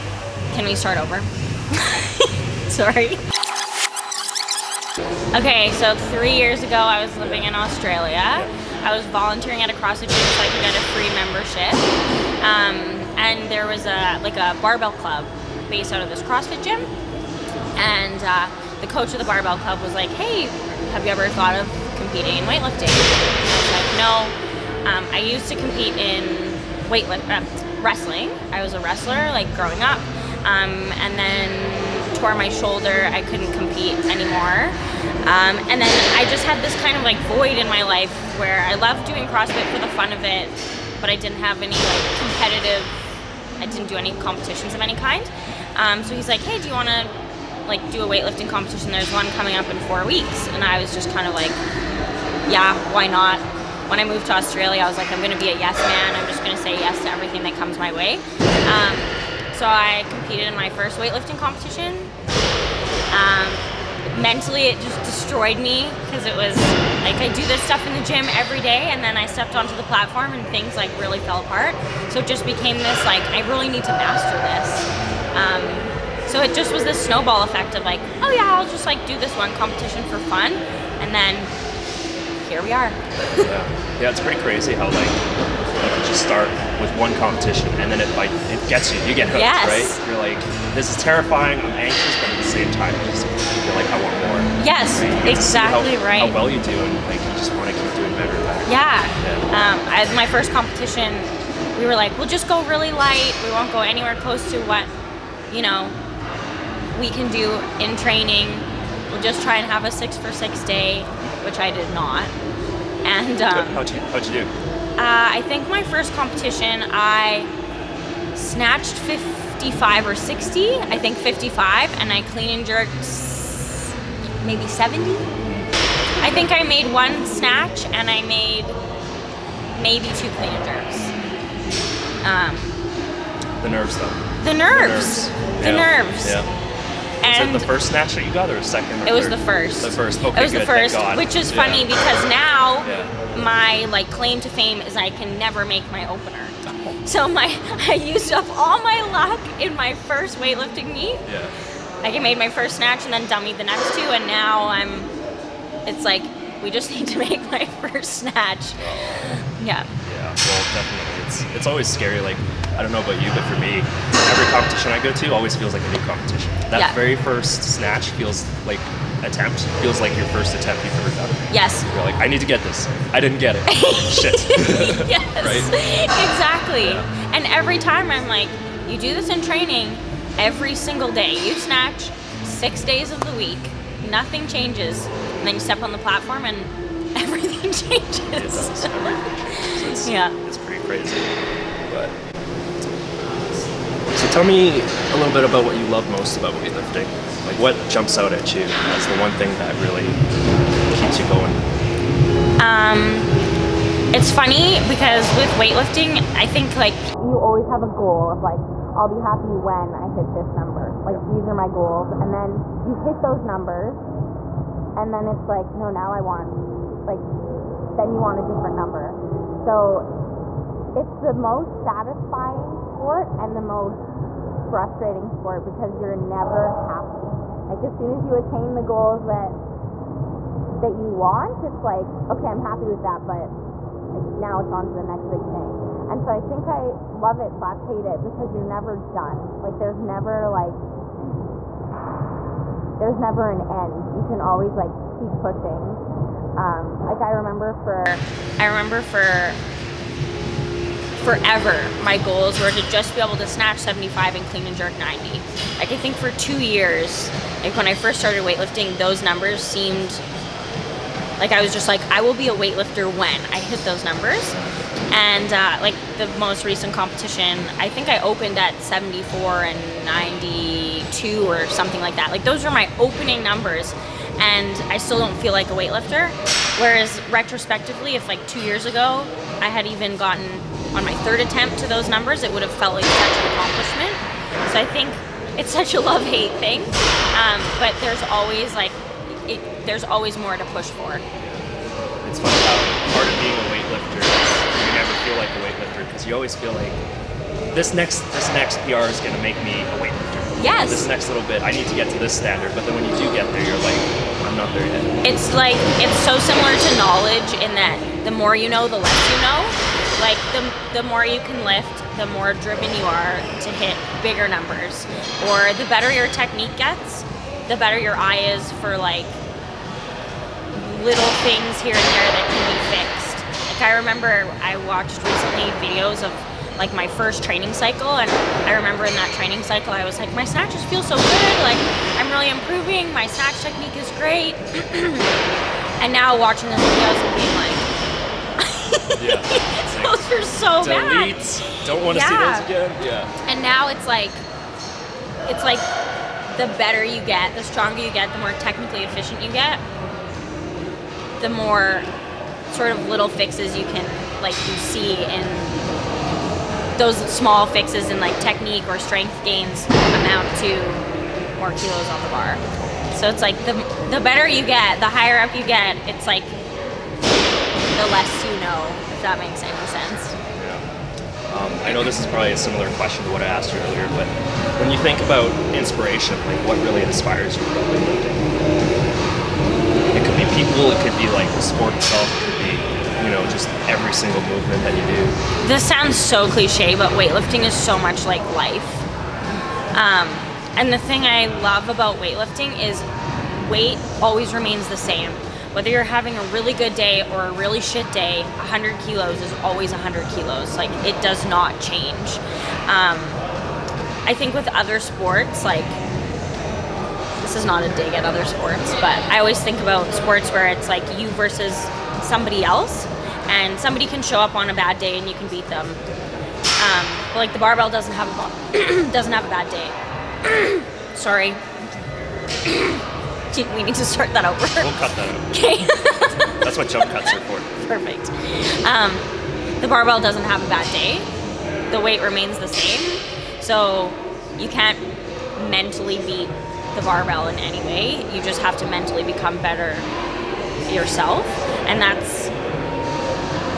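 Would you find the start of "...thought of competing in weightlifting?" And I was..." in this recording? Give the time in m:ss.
0:21.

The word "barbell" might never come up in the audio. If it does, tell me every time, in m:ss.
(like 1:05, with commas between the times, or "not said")
0:14, 0:19, 6:57, 7:09, 7:17.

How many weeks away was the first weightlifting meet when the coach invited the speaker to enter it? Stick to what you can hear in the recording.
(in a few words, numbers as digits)
4.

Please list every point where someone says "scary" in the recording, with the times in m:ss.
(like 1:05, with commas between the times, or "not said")
2:41.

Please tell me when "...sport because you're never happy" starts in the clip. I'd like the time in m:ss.
3:45.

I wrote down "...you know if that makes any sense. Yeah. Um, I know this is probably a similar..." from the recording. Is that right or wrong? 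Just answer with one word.
right.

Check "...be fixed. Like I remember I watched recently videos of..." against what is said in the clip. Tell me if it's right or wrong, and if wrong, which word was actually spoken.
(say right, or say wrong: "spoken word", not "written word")
right.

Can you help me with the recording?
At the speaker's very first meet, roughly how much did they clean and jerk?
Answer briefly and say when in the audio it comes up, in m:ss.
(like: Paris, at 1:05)
70, at 2:04.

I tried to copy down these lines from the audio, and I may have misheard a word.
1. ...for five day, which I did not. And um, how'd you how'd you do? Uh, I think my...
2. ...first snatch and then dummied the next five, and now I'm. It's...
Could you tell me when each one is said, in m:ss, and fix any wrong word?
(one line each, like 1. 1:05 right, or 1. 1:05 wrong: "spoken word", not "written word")
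1. 1:50 wrong: "six", not "five"
2. 2:32 wrong: "two", not "five".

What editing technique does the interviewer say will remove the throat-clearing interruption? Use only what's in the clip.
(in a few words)
Jump cuts.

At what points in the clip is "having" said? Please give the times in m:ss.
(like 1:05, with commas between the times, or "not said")
6:36.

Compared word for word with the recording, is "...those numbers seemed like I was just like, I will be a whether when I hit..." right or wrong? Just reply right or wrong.
wrong.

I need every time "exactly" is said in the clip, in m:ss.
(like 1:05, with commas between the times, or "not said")
1:35, 2:56.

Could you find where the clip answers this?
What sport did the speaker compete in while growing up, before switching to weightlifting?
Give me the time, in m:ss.
0:27.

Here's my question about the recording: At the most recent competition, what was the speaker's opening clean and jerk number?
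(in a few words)
92.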